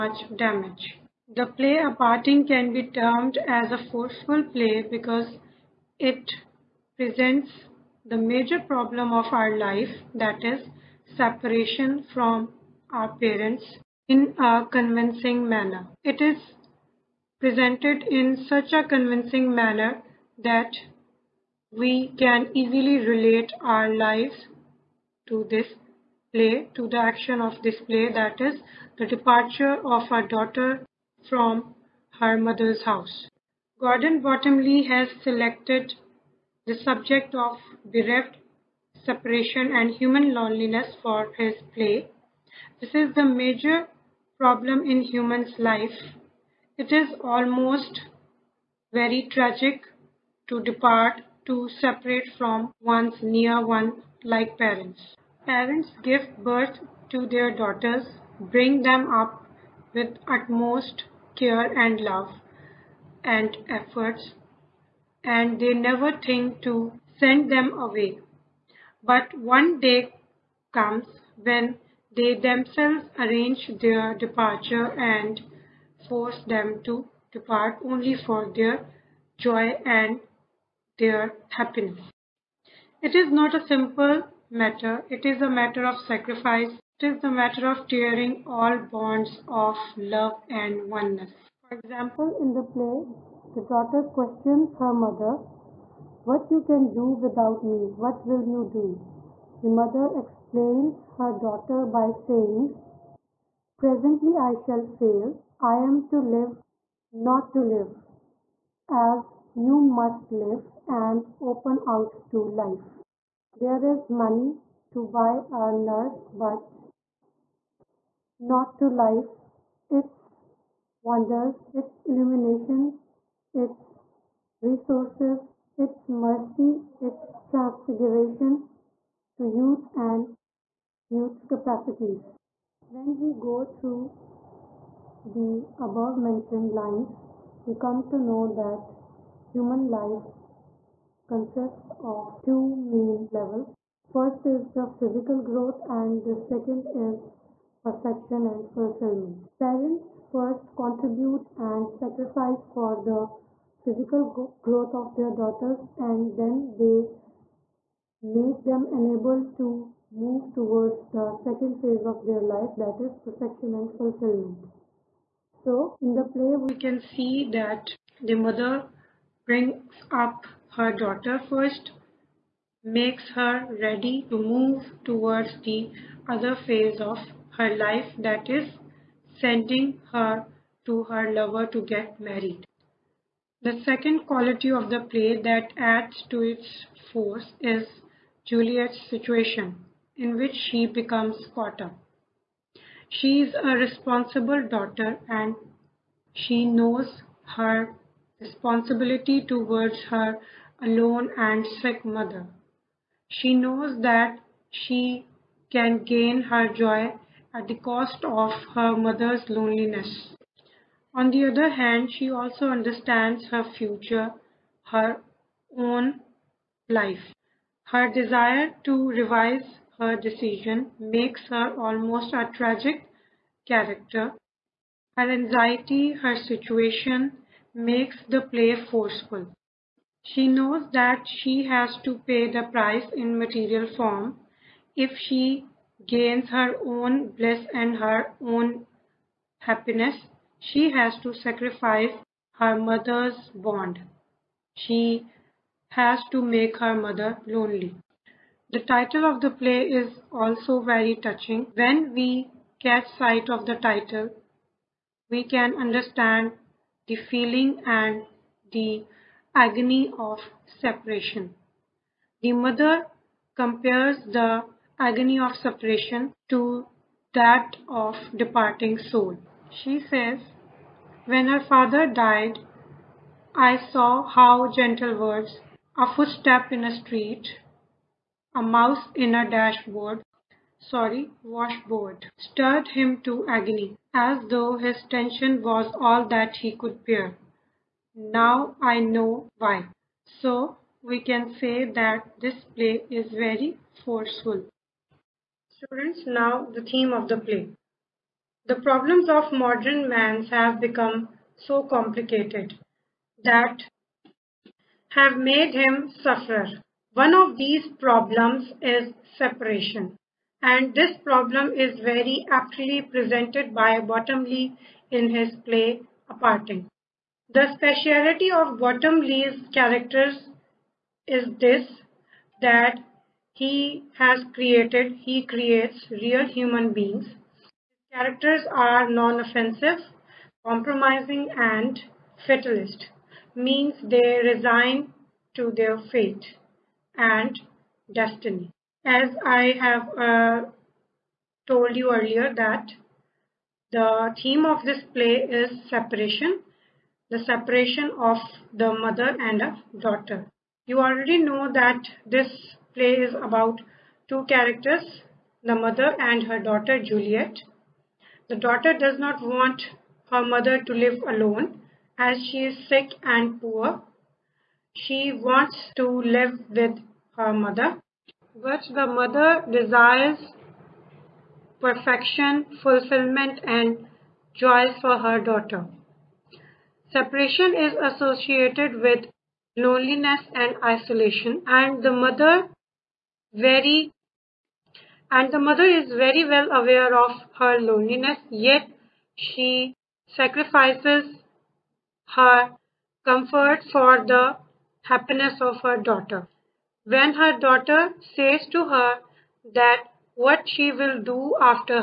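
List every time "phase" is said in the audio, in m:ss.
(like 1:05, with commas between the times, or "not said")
2:41, 2:56.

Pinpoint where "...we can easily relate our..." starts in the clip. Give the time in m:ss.
0:21.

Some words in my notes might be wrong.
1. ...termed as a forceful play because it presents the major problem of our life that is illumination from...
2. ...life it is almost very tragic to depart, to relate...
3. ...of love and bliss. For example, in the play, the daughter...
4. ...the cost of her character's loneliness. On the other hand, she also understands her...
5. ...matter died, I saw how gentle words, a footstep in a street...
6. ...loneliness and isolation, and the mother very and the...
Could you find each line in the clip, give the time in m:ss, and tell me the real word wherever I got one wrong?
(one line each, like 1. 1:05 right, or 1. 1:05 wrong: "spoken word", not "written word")
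1. 0:02 wrong: "separation", not "illumination"
2. 0:45 wrong: "separate", not "relate"
3. 1:29 wrong: "oneness", not "bliss"
4. 3:27 wrong: "mother", not "character"
5. 4:31 wrong: "father", not "matter"
6. 6:19 right.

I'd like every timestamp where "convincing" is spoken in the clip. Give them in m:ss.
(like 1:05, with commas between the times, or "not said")
0:14, 0:18.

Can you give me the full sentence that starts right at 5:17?
The speciality of Bottomley's characters is this that he has created, he creates real human beings.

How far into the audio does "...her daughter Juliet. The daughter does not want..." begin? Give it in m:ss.
5:56.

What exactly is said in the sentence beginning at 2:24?
First is the physical growth and the second is perfection and fulfillment.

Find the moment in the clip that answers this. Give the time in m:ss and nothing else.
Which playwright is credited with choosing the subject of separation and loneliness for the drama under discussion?
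0:33.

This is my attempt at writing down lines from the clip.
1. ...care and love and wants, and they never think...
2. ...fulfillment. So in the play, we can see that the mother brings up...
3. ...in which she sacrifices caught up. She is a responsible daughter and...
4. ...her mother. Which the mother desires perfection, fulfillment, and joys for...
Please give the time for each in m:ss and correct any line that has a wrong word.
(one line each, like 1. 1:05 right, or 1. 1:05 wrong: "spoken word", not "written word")
1. 1:01 wrong: "efforts", not "wants"
2. 2:43 right
3. 3:10 wrong: "becomes", not "sacrifices"
4. 6:07 right.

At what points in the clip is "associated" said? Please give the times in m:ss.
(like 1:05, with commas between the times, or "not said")
6:18.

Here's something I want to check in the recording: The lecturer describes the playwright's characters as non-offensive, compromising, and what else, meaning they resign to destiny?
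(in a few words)
fatalist.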